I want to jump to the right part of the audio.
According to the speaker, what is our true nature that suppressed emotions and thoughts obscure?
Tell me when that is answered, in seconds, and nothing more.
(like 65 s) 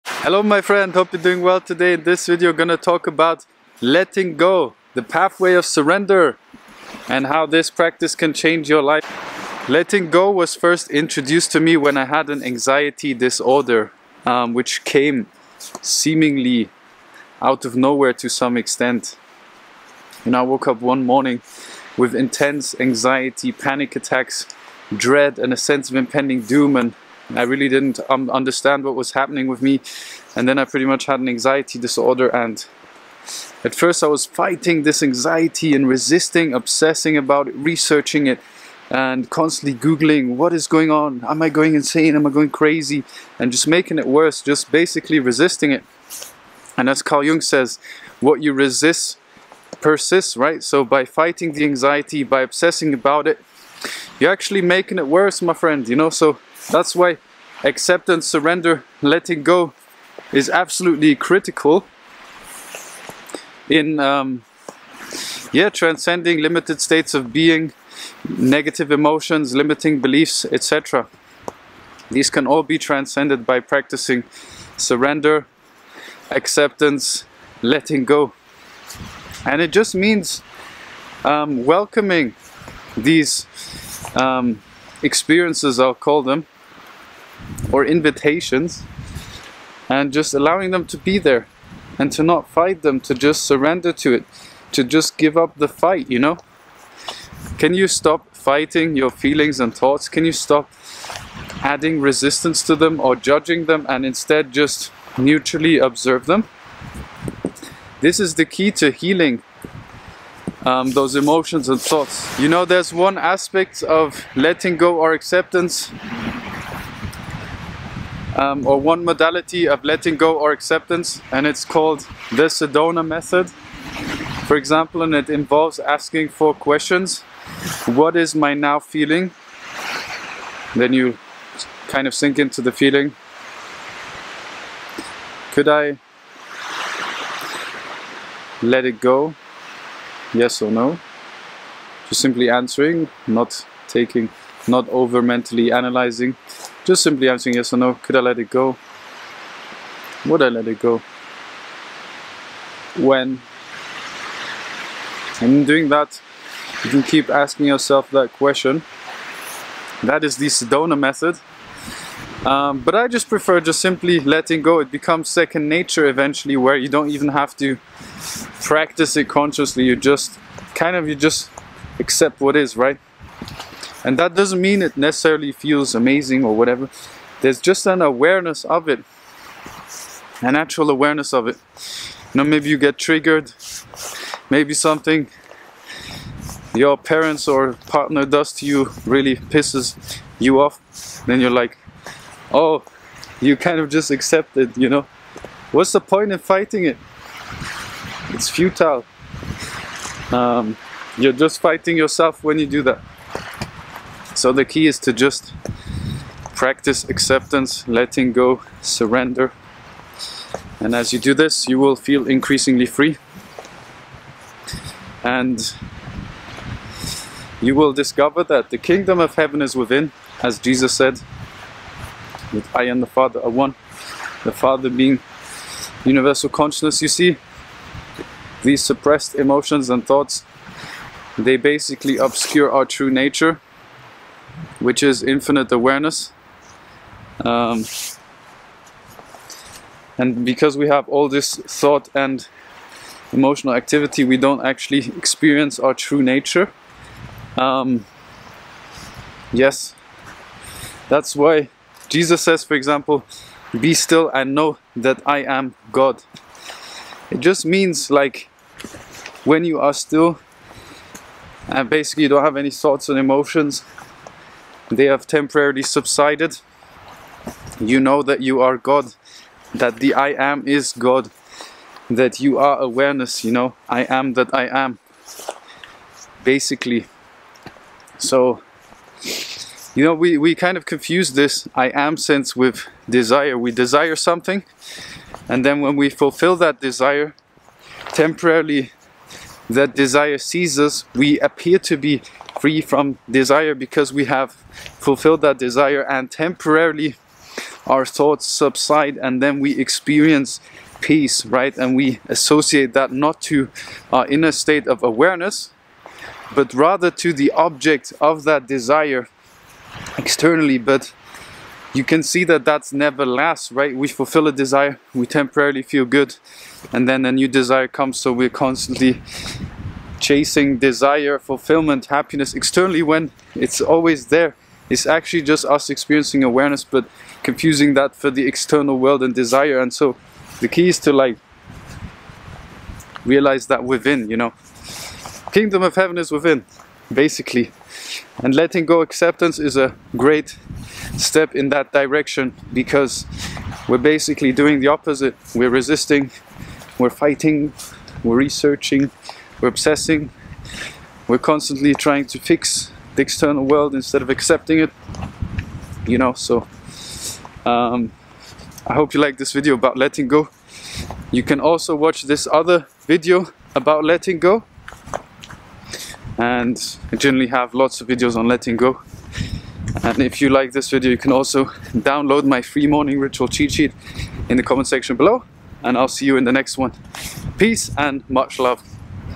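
235 s.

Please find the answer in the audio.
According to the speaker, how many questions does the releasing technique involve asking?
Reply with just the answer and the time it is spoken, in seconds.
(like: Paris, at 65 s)
4, at 126 s.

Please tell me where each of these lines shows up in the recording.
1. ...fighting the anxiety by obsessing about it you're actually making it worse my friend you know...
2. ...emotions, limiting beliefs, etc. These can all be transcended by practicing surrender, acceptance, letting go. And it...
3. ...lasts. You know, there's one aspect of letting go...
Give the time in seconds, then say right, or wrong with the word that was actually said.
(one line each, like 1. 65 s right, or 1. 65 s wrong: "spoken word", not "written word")
1. 51 s right
2. 68 s right
3. 111 s wrong: "thoughts", not "lasts".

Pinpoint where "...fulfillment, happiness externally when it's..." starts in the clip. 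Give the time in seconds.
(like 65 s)
321 s.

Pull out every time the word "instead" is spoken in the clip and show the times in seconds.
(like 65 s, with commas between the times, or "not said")
104 s, 353 s.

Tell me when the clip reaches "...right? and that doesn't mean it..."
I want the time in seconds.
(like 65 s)
172 s.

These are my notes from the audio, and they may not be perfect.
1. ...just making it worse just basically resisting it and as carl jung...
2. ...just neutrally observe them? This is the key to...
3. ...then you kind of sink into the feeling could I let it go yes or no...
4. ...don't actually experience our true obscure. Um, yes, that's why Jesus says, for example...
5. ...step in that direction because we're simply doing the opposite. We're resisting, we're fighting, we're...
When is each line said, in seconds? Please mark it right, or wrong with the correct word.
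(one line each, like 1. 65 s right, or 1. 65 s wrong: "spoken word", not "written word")
1. 43 s right
2. 104 s right
3. 130 s right
4. 244 s wrong: "nature", not "obscure"
5. 341 s wrong: "basically", not "simply".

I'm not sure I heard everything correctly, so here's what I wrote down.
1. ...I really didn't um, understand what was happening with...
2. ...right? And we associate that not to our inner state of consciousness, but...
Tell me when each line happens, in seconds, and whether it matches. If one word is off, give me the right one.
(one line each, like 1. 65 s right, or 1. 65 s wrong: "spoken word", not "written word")
1. 27 s right
2. 301 s wrong: "awareness", not "consciousness".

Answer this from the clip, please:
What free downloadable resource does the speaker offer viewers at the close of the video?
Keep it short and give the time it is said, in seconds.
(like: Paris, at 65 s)
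Morning ritual cheat sheet, at 372 s.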